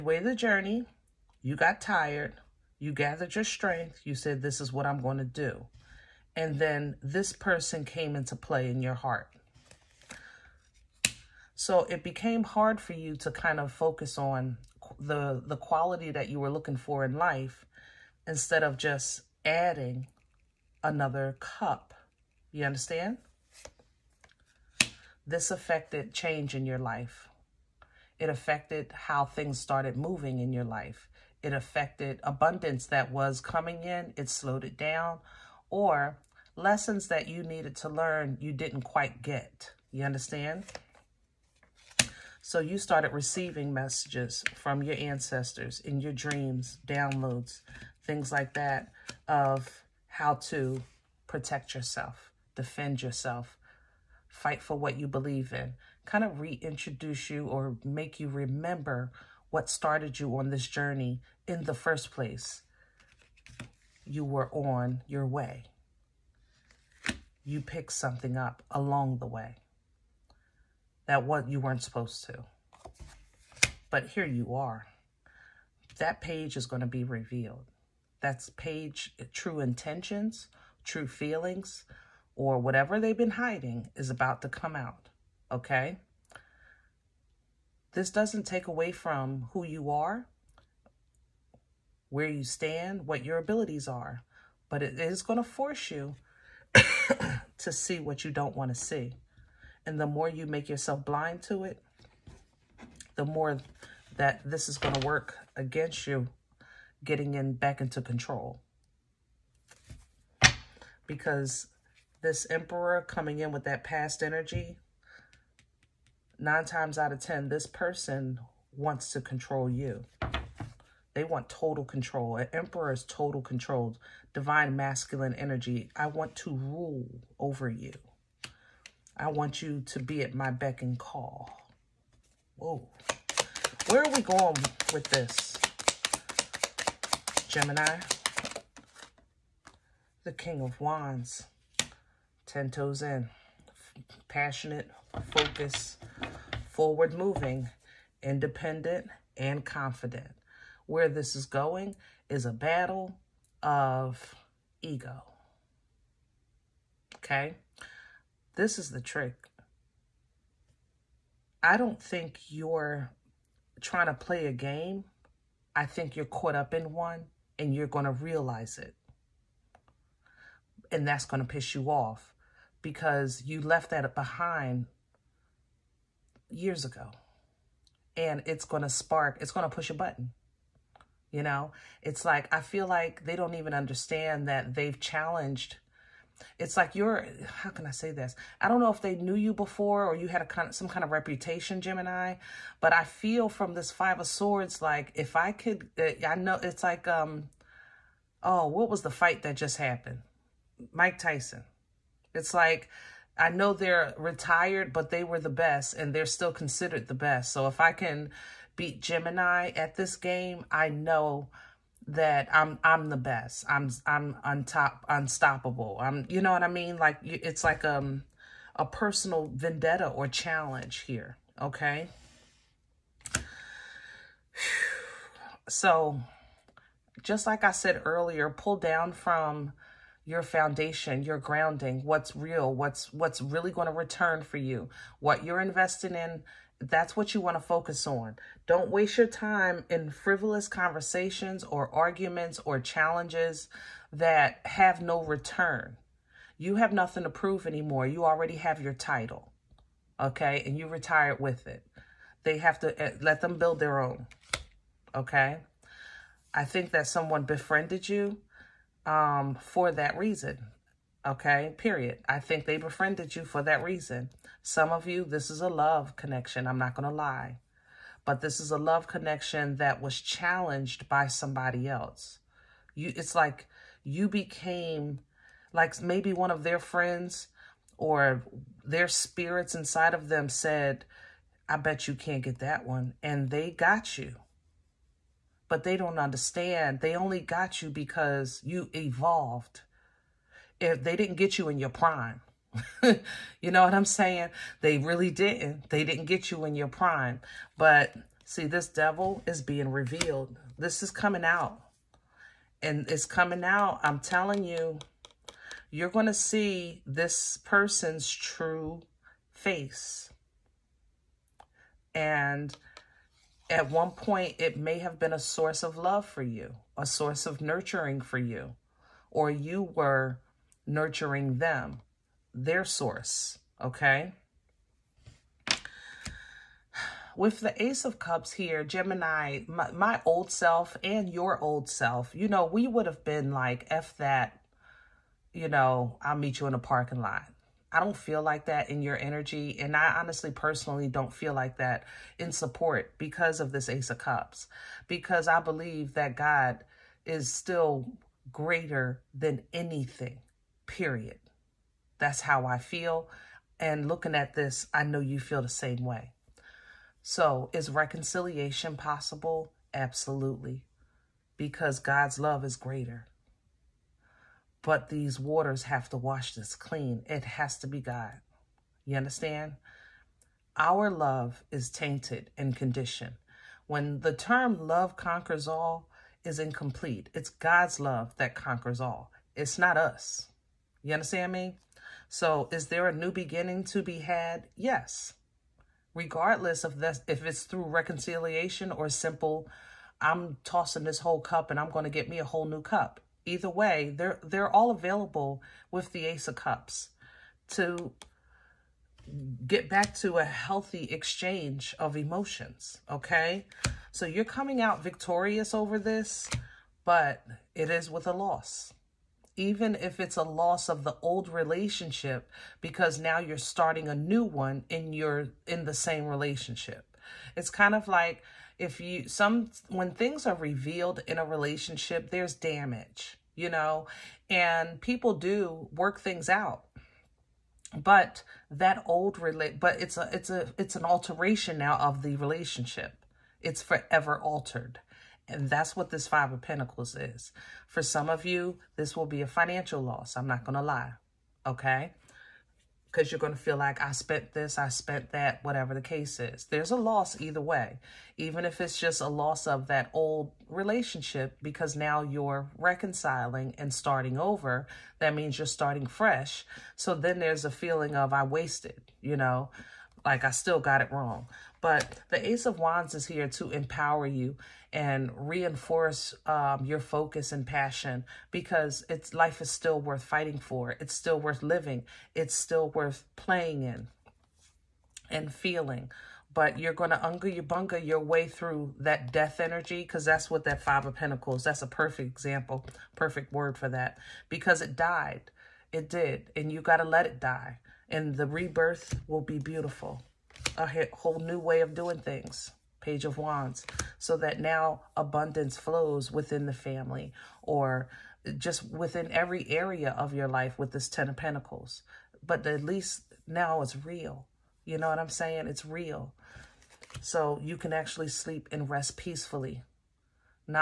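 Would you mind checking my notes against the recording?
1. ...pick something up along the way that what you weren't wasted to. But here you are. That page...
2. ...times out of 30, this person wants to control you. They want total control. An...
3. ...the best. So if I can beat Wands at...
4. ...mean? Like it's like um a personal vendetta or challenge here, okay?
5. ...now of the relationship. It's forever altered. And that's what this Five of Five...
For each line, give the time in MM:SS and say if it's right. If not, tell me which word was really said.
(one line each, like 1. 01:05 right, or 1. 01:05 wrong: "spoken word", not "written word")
1. 01:07 wrong: "supposed", not "wasted"
2. 01:56 wrong: "10", not "30"
3. 03:27 wrong: "Gemini", not "Wands"
4. 03:36 right
5. 07:11 wrong: "Pentacles", not "Five".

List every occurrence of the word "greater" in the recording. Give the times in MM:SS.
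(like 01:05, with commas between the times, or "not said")
05:48, 06:02.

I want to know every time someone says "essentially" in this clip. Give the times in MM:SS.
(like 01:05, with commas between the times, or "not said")
not said.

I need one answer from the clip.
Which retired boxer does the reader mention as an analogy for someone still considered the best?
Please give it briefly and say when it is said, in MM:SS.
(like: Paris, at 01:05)
Mike Tyson, at 03:20.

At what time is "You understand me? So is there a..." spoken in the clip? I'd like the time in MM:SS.
06:21.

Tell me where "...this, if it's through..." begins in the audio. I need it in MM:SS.
06:26.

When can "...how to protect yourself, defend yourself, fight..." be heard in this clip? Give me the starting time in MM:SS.
00:50.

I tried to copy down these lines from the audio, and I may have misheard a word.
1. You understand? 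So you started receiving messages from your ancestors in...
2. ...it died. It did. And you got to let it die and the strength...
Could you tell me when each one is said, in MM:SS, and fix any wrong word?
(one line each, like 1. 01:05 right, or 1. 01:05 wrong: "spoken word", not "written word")
1. 00:39 right
2. 08:04 wrong: "rebirth", not "strength".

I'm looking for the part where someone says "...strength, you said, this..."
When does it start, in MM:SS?
00:03.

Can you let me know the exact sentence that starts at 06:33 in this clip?
Either way, they're, they're all available with the Ace of Cups to get back to a healthy exchange of emotions, okay?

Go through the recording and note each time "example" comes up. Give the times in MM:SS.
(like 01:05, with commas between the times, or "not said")
08:02.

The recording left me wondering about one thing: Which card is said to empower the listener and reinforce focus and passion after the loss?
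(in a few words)
Ace of Wands.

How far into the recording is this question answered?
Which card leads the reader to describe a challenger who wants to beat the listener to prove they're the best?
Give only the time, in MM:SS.
03:13.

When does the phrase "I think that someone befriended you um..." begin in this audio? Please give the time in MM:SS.
04:16.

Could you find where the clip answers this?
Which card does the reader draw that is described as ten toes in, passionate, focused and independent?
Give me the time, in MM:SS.
02:20.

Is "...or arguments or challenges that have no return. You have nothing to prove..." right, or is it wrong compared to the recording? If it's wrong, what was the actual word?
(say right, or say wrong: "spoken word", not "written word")
right.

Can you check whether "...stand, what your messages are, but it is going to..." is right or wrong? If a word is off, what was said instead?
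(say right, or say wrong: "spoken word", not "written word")
wrong: "abilities", not "messages".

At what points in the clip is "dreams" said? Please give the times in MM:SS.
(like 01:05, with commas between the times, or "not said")
00:46.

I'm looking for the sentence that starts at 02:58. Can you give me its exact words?
And it's going to spark, it's going to push a button.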